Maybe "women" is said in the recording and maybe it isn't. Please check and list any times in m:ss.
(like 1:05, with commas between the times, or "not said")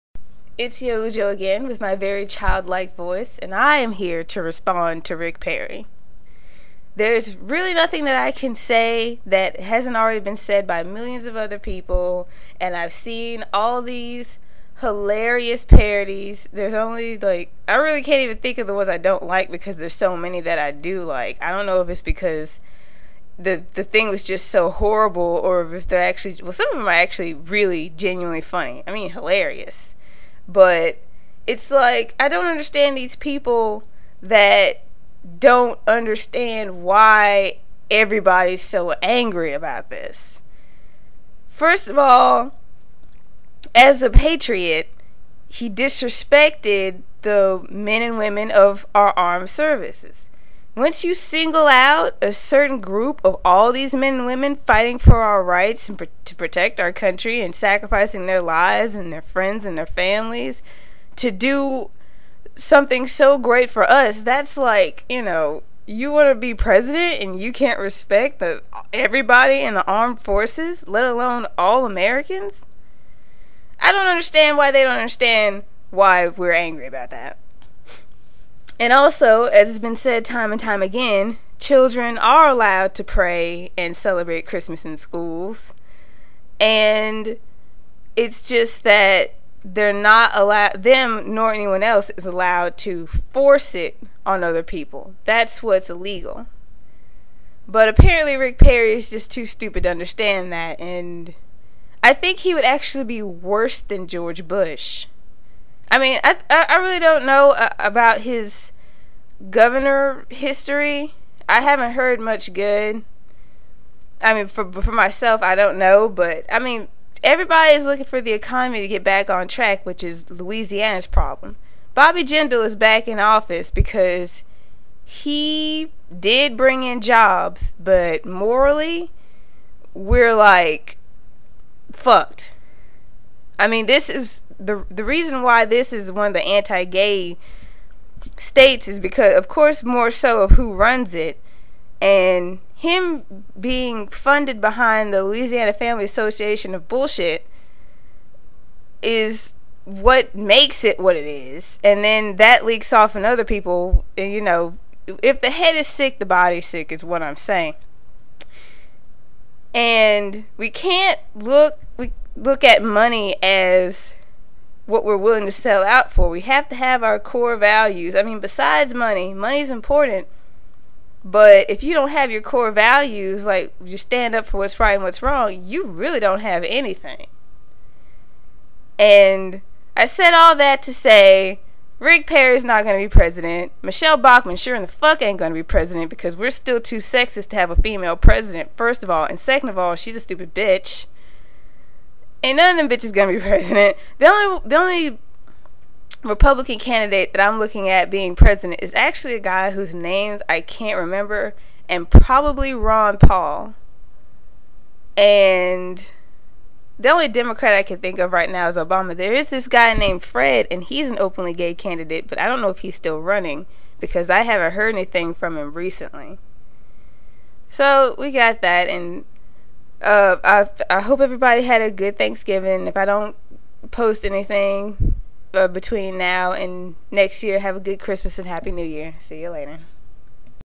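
0:48, 0:54.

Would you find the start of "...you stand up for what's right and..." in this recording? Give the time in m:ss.
2:53.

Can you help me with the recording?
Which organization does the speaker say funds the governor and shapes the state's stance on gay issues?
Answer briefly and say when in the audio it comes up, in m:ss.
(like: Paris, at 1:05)
Louisiana Family Association, at 2:25.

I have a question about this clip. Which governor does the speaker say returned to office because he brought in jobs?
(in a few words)
Bobby Jindal.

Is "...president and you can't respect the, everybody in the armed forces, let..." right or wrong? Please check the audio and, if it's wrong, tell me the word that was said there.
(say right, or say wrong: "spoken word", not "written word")
right.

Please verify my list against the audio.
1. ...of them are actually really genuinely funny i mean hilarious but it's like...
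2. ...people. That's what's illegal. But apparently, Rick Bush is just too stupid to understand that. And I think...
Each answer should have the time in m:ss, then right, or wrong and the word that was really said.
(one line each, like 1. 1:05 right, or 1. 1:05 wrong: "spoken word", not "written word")
1. 0:26 right
2. 1:34 wrong: "Perry", not "Bush".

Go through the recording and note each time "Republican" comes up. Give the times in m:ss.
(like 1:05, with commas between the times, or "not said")
3:16.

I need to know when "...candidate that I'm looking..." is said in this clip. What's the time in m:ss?
3:16.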